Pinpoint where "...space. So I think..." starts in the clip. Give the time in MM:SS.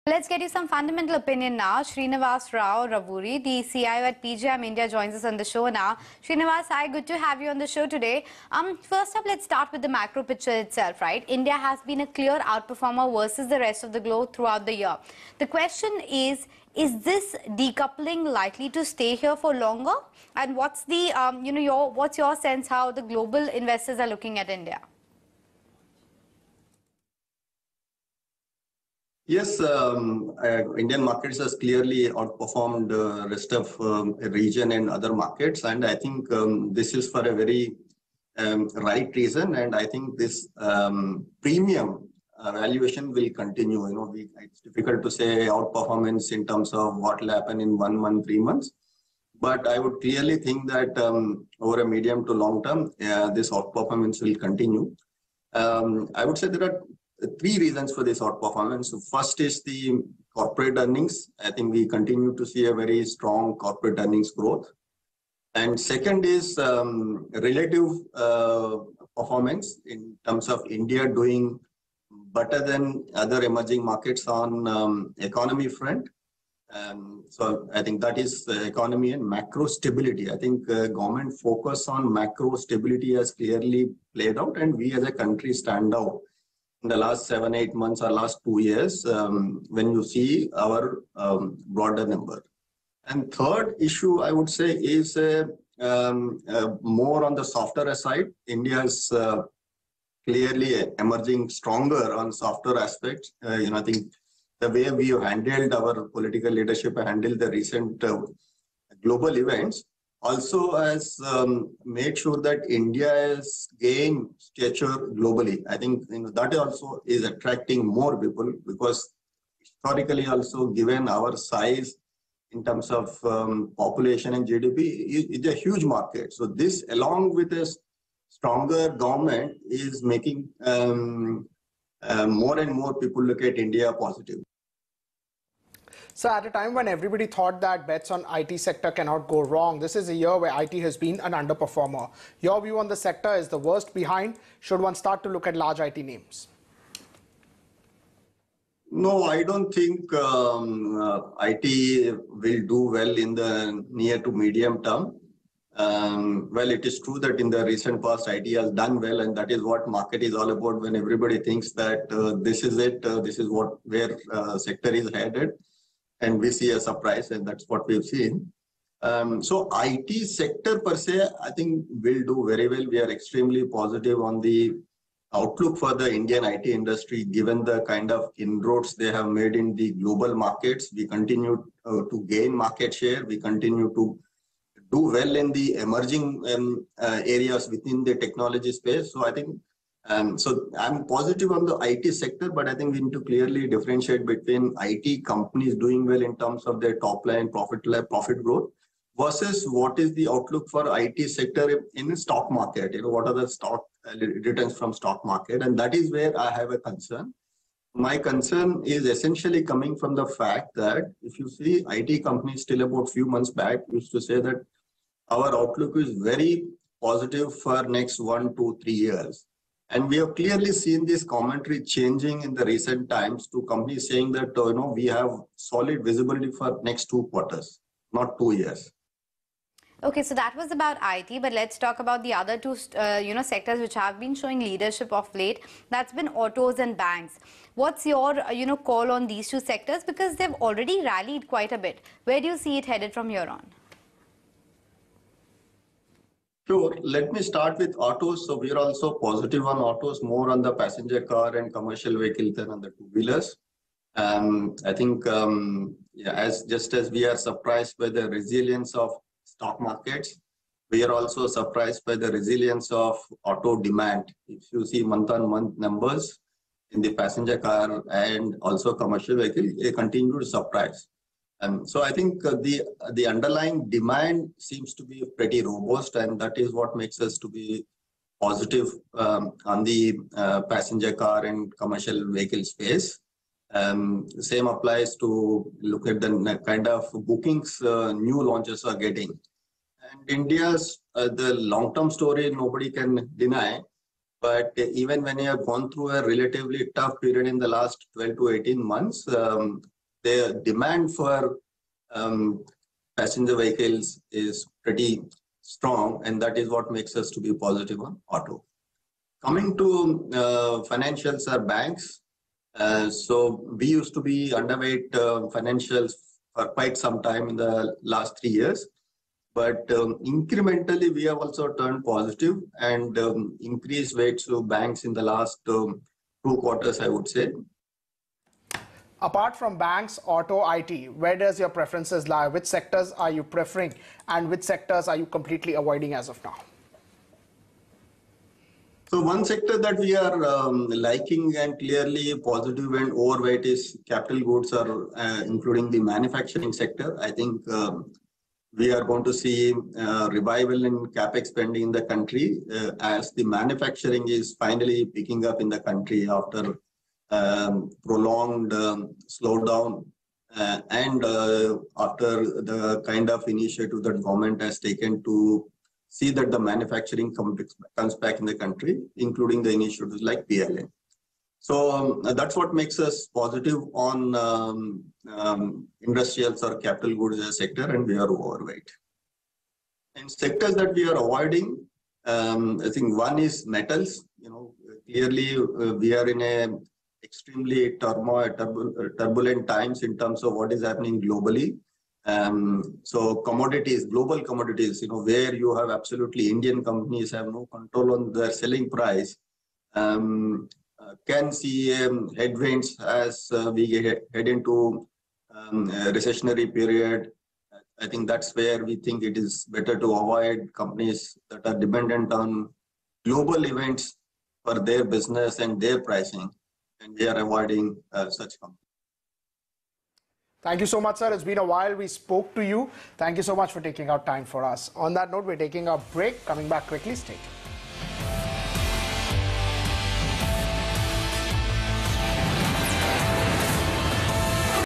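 03:08.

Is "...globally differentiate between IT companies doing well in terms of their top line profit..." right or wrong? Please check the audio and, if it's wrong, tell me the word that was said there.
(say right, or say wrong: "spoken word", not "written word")
wrong: "clearly", not "globally".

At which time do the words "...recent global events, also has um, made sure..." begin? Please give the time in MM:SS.
01:47.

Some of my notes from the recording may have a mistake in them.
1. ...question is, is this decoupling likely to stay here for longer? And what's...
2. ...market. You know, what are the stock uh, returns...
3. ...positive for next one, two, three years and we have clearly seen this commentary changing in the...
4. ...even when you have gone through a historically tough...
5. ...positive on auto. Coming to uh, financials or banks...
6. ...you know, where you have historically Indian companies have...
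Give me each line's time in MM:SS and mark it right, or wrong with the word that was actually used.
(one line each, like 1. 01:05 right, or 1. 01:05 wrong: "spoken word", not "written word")
1. 00:15 right
2. 03:22 right
3. 03:37 right
4. 04:54 wrong: "relatively", not "historically"
5. 05:07 right
6. 06:35 wrong: "absolutely", not "historically".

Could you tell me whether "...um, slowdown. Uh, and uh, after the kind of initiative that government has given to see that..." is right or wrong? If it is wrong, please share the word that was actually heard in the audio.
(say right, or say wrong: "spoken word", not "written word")
wrong: "taken", not "given".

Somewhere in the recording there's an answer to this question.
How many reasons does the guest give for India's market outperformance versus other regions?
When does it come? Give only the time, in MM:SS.
00:57.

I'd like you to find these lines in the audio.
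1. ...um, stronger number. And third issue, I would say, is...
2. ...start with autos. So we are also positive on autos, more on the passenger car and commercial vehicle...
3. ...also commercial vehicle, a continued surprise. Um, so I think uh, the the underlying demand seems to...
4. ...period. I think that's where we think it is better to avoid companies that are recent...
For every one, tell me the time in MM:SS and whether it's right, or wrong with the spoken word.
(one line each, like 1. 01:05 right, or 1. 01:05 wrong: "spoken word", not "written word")
1. 01:31 wrong: "broader", not "stronger"
2. 04:07 right
3. 04:28 right
4. 06:46 wrong: "dependent", not "recent".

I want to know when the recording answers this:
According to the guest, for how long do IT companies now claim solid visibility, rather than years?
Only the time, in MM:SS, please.
03:46.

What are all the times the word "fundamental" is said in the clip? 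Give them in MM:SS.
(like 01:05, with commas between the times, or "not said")
00:00.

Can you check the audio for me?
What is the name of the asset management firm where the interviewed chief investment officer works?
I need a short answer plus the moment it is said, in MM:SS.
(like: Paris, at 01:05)
PGIM India, at 00:04.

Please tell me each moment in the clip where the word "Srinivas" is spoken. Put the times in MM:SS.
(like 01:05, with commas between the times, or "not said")
00:01, 00:06.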